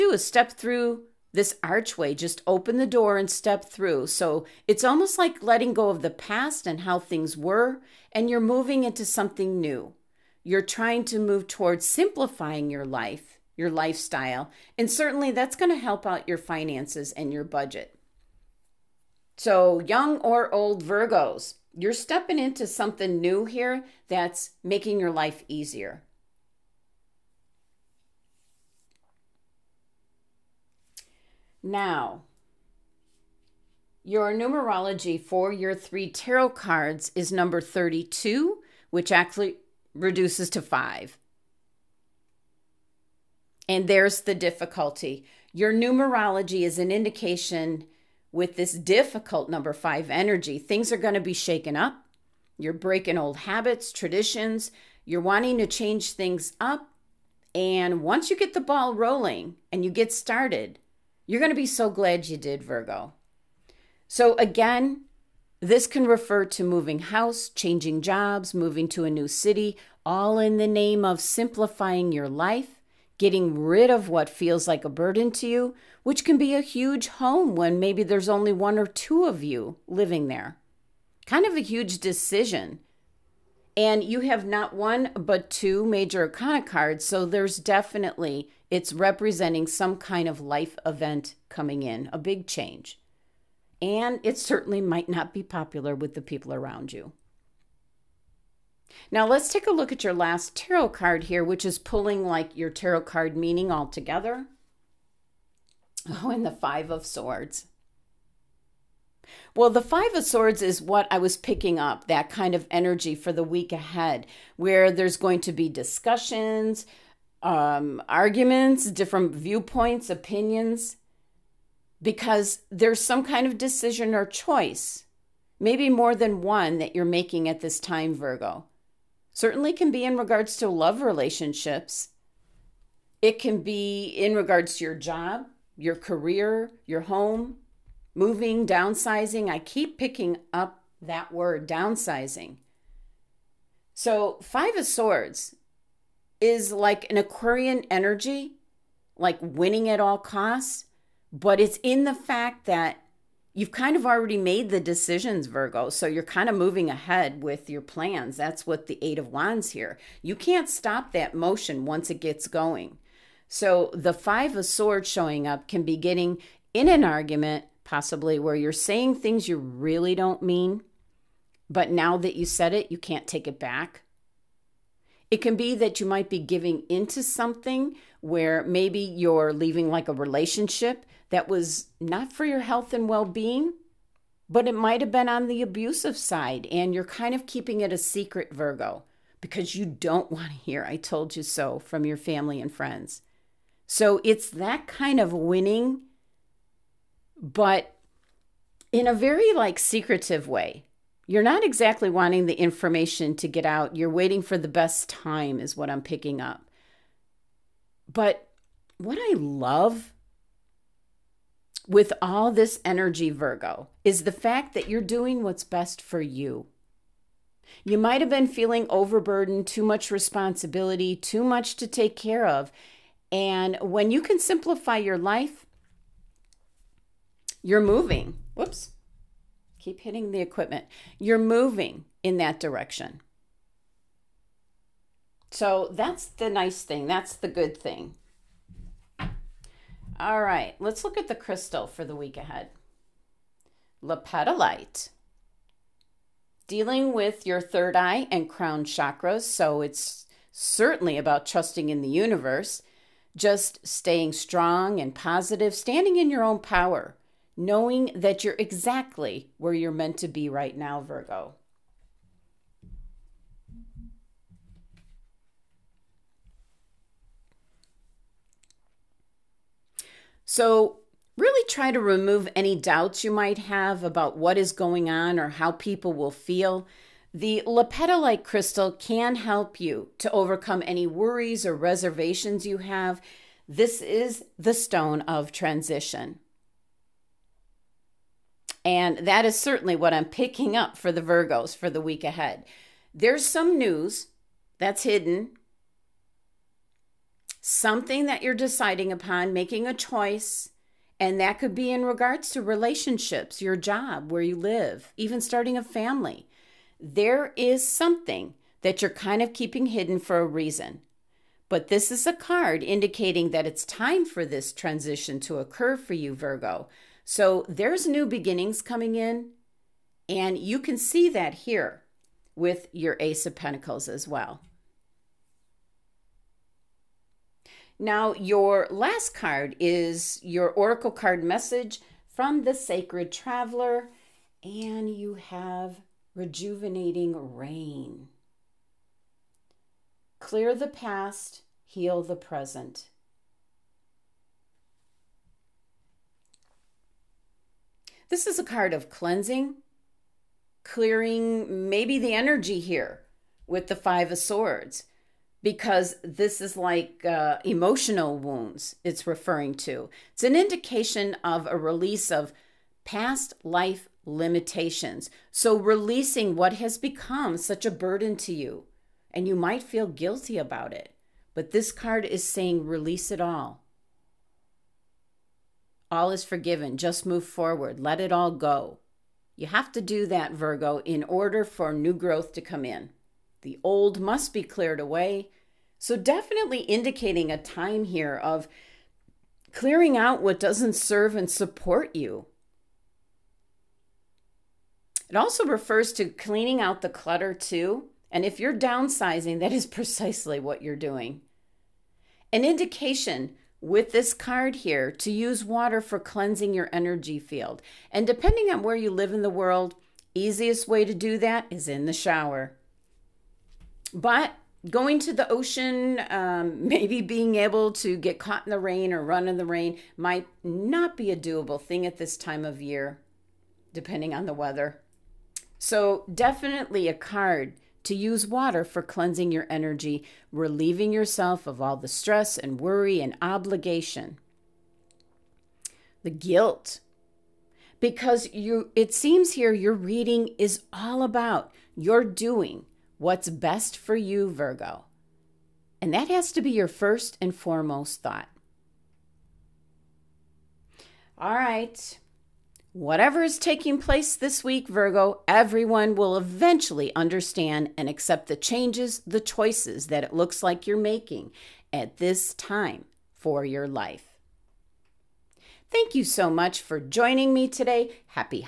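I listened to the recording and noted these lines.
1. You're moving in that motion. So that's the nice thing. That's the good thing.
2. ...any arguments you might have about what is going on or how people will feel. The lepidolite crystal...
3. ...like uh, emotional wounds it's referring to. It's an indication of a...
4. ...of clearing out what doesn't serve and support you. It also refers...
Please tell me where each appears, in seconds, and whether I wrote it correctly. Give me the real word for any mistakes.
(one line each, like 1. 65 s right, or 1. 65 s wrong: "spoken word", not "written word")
1. 231 s wrong: "direction", not "motion"
2. 272 s wrong: "doubts", not "arguments"
3. 356 s right
4. 388 s right.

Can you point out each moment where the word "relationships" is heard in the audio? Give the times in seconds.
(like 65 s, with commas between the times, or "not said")
131 s, 180 s, 302 s.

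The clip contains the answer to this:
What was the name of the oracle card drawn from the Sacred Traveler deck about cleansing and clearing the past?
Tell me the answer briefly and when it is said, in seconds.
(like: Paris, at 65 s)
Rejuvenating rain, at 336 s.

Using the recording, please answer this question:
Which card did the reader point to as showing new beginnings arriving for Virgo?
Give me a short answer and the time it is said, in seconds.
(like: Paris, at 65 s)
Ace of Pentacles, at 323 s.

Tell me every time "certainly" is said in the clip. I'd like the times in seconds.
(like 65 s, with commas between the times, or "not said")
14 s, 94 s, 129 s, 250 s, 289 s.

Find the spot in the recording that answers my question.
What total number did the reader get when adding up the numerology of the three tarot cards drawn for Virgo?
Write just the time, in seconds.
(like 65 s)
37 s.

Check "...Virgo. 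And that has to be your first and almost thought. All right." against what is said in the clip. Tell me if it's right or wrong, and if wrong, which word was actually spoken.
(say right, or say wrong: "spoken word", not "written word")
wrong: "foremost", not "almost".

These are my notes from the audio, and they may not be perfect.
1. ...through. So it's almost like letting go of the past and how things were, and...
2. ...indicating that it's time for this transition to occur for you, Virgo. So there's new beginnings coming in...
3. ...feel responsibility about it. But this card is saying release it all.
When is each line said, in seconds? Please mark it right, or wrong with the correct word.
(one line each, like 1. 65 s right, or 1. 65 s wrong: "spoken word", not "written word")
1. 3 s right
2. 312 s right
3. 369 s wrong: "guilty", not "responsibility".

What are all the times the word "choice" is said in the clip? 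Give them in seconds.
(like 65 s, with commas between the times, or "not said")
124 s, 299 s, 459 s.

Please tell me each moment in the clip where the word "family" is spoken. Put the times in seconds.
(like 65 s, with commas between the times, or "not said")
192 s, 305 s.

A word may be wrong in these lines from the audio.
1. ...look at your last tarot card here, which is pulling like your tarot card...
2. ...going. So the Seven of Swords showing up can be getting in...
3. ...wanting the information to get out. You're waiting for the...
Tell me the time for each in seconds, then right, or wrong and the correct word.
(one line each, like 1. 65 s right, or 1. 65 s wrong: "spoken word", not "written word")
1. 99 s right
2. 162 s wrong: "Five", not "Seven"
3. 202 s right.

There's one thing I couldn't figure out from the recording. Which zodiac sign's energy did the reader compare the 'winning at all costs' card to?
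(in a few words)
Aquarian.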